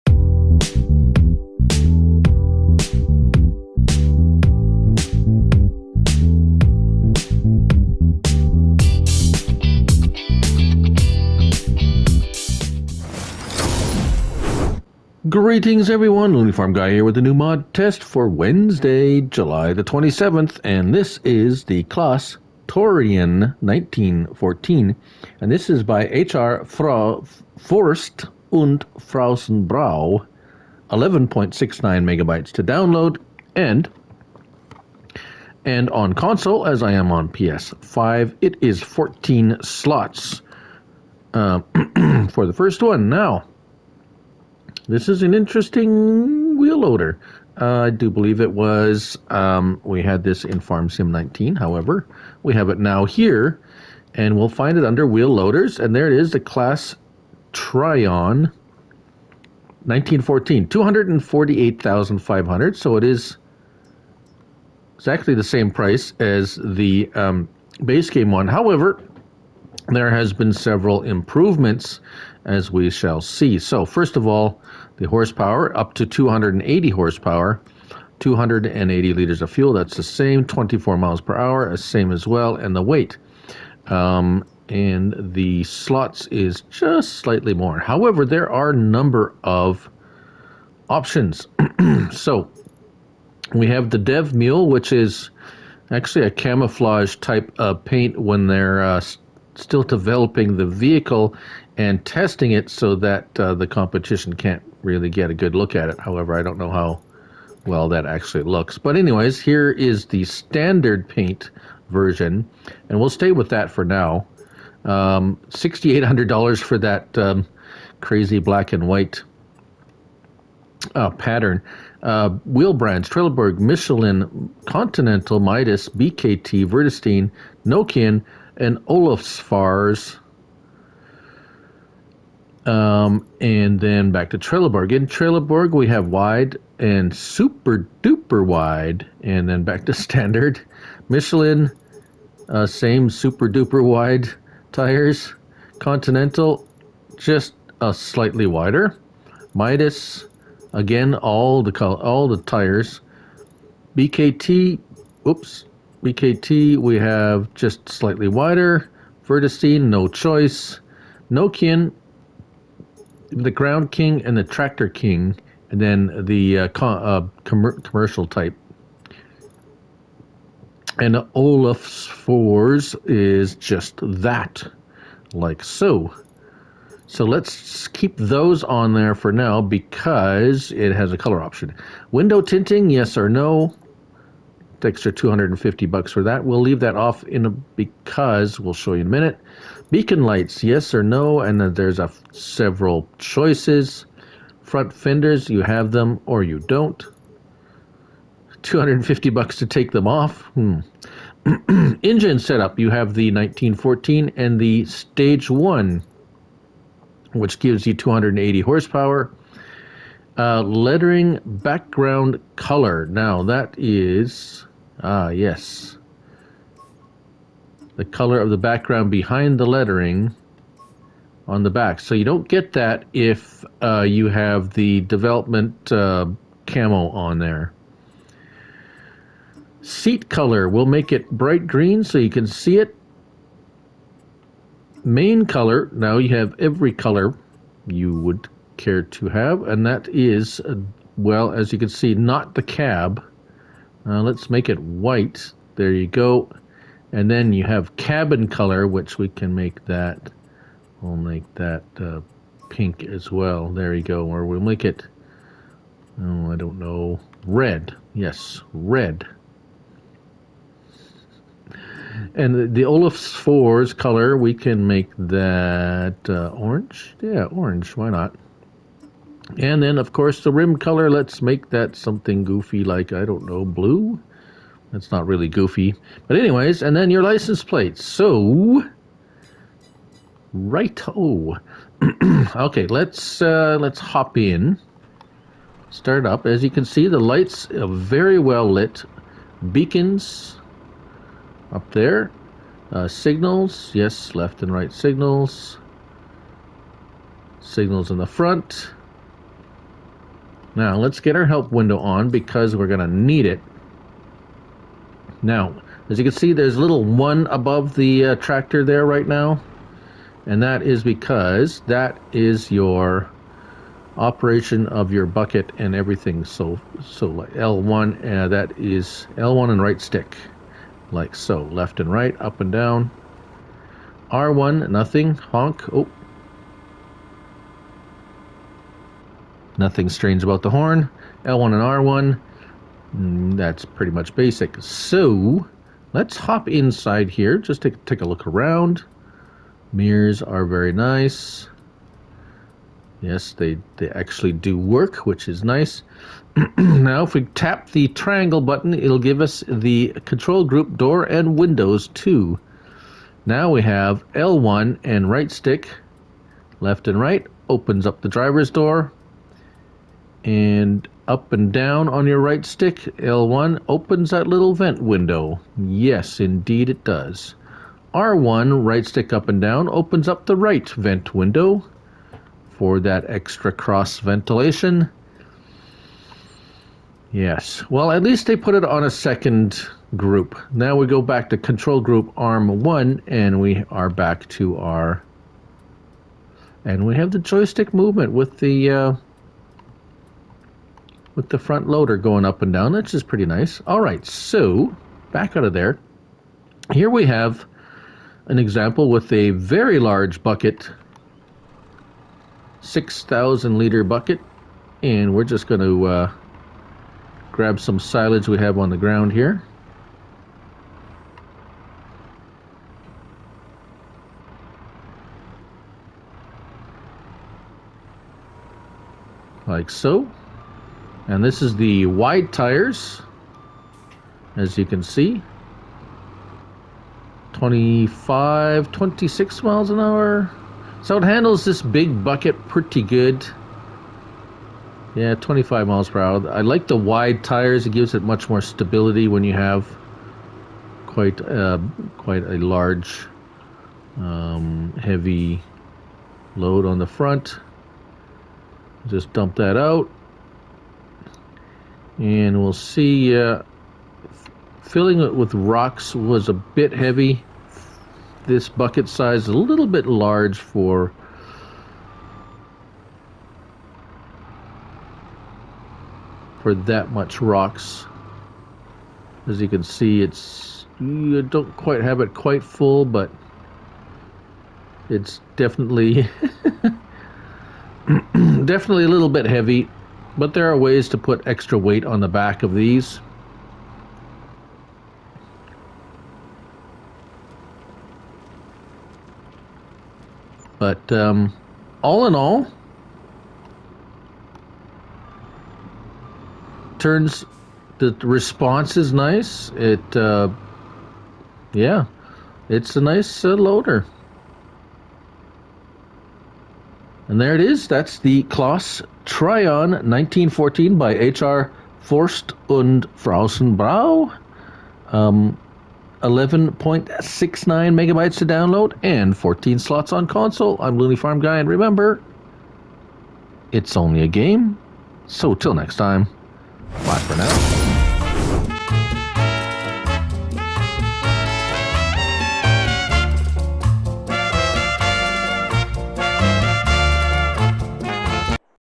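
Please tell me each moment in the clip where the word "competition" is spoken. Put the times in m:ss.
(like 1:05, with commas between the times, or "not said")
1:43.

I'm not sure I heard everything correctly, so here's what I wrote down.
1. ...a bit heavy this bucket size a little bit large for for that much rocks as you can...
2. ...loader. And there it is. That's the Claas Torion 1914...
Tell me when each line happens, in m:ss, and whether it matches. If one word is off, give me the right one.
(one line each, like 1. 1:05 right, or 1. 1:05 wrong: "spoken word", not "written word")
1. 7:36 right
2. 8:23 right.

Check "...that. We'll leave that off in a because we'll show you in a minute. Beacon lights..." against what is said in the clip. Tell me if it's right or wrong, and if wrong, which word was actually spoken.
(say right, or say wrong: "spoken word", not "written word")
right.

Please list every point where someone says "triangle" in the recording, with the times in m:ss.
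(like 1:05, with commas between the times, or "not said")
5:48.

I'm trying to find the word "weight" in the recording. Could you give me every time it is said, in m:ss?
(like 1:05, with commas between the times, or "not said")
1:22, 8:01.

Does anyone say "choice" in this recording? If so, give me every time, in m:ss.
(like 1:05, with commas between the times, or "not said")
2:40, 3:13.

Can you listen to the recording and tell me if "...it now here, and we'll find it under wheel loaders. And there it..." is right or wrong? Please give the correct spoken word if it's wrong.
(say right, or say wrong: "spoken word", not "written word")
right.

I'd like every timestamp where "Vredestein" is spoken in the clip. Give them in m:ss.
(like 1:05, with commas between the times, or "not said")
2:06, 2:39.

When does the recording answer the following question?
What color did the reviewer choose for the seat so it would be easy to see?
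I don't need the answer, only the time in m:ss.
3:51.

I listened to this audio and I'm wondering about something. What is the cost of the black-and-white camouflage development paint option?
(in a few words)
$6,800.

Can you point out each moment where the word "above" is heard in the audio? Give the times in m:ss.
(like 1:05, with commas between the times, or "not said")
5:07.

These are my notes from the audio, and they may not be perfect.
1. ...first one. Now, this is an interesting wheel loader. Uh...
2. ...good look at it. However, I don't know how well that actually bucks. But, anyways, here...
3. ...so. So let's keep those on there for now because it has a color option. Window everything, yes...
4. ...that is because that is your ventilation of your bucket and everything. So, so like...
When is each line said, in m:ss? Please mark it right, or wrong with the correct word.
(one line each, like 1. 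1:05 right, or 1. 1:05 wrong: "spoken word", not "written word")
1. 0:42 right
2. 1:45 wrong: "looks", not "bucks"
3. 2:55 wrong: "tinting", not "everything"
4. 5:10 wrong: "operation", not "ventilation".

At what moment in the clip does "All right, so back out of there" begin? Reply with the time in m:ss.
6:33.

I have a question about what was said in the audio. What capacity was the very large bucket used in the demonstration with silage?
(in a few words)
6,000 liters.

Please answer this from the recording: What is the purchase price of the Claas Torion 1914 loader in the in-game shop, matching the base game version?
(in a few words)
248,500.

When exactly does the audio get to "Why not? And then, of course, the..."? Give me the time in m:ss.
4:27.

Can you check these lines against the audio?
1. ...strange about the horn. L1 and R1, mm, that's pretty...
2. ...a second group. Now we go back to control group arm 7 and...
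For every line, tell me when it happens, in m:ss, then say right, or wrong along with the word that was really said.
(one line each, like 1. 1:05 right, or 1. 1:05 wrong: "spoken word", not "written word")
1. 5:30 right
2. 6:19 wrong: "1", not "7".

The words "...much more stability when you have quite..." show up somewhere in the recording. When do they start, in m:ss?
7:18.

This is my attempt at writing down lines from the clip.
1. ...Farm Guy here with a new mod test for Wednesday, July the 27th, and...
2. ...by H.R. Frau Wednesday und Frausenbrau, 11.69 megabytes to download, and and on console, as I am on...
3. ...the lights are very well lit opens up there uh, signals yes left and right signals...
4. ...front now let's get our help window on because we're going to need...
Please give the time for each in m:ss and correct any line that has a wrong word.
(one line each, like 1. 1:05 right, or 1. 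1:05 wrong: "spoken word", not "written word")
1. 0:16 right
2. 0:25 wrong: "Forst", not "Wednesday"
3. 4:47 wrong: "beacons", not "opens"
4. 4:58 right.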